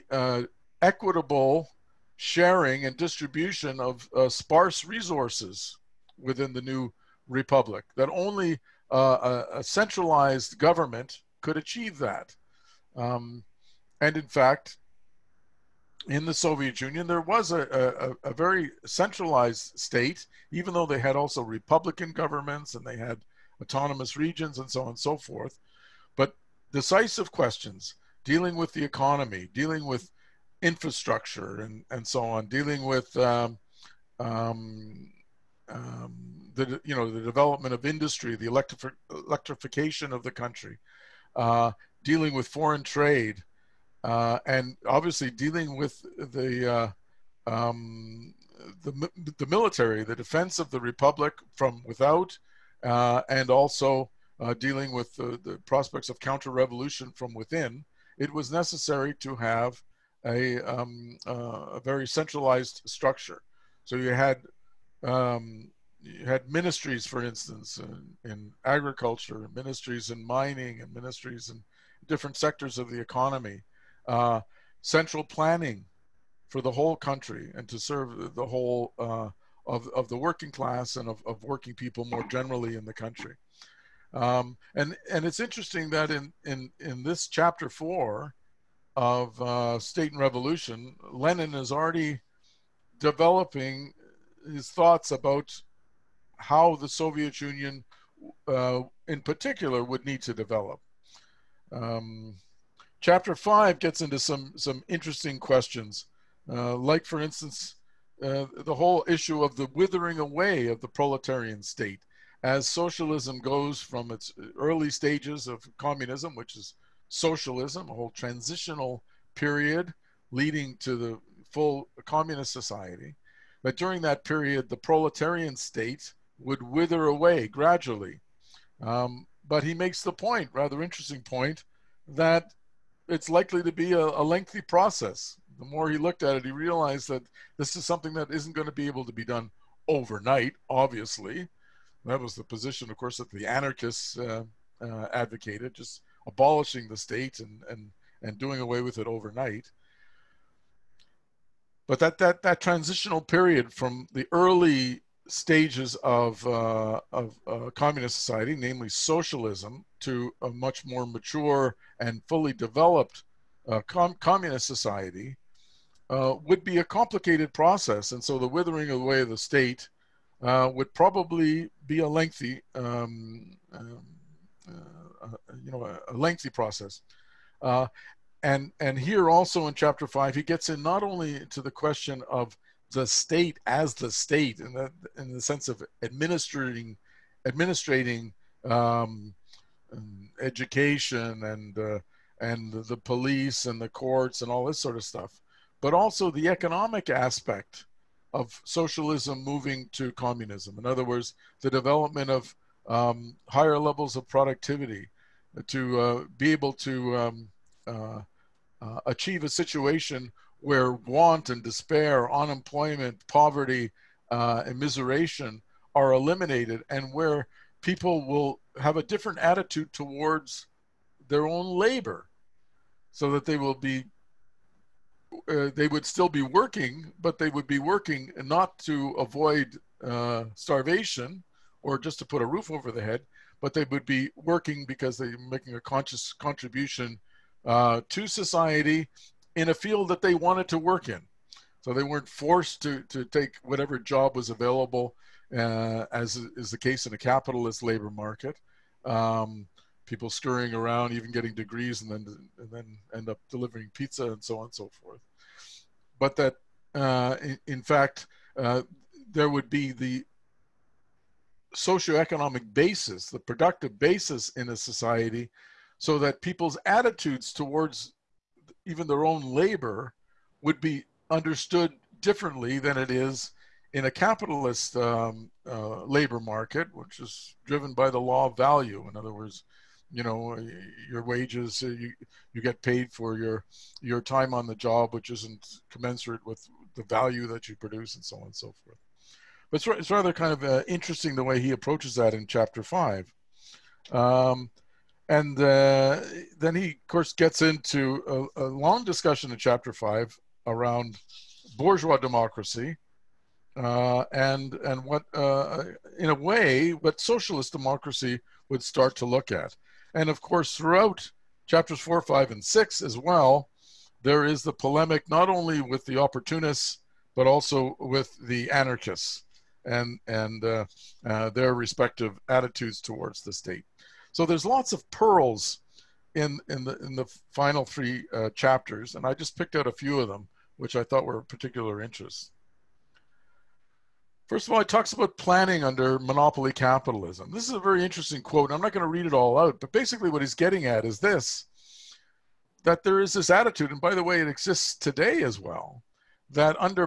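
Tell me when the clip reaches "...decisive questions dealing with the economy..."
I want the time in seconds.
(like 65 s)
26 s.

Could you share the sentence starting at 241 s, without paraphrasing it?
So they weren't forced to, to take whatever job was available, uh, as is the case in a capitalist labor market.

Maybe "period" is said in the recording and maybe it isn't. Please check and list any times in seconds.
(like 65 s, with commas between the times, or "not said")
119 s, 124 s, 153 s.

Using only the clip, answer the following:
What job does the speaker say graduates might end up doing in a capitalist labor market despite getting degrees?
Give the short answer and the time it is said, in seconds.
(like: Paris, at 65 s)
delivering pizza, at 253 s.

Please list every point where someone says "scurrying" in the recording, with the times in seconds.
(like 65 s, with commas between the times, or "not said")
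250 s.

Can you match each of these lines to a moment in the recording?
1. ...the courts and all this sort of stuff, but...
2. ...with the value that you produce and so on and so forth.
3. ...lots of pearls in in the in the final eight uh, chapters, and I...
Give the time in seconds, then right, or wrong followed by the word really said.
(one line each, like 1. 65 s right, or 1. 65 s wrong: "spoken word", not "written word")
1. 193 s right
2. 286 s right
3. 324 s wrong: "three", not "eight".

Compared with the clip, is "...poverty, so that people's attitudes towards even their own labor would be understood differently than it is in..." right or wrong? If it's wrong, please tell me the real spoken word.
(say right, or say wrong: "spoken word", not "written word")
wrong: "society", not "poverty".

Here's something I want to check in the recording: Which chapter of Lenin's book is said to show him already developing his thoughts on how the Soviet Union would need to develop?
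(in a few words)
Chapter 4.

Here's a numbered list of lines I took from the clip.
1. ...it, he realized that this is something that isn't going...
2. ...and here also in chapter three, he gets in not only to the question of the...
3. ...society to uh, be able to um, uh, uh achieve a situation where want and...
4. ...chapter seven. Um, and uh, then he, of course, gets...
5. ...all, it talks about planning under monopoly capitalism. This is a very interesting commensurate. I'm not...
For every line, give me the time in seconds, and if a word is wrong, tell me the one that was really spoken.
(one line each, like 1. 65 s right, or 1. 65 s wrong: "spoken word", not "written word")
1. 136 s right
2. 178 s wrong: "five", not "three"
3. 204 s wrong: "productivity", not "society"
4. 292 s wrong: "five", not "seven"
5. 334 s wrong: "quote", not "commensurate".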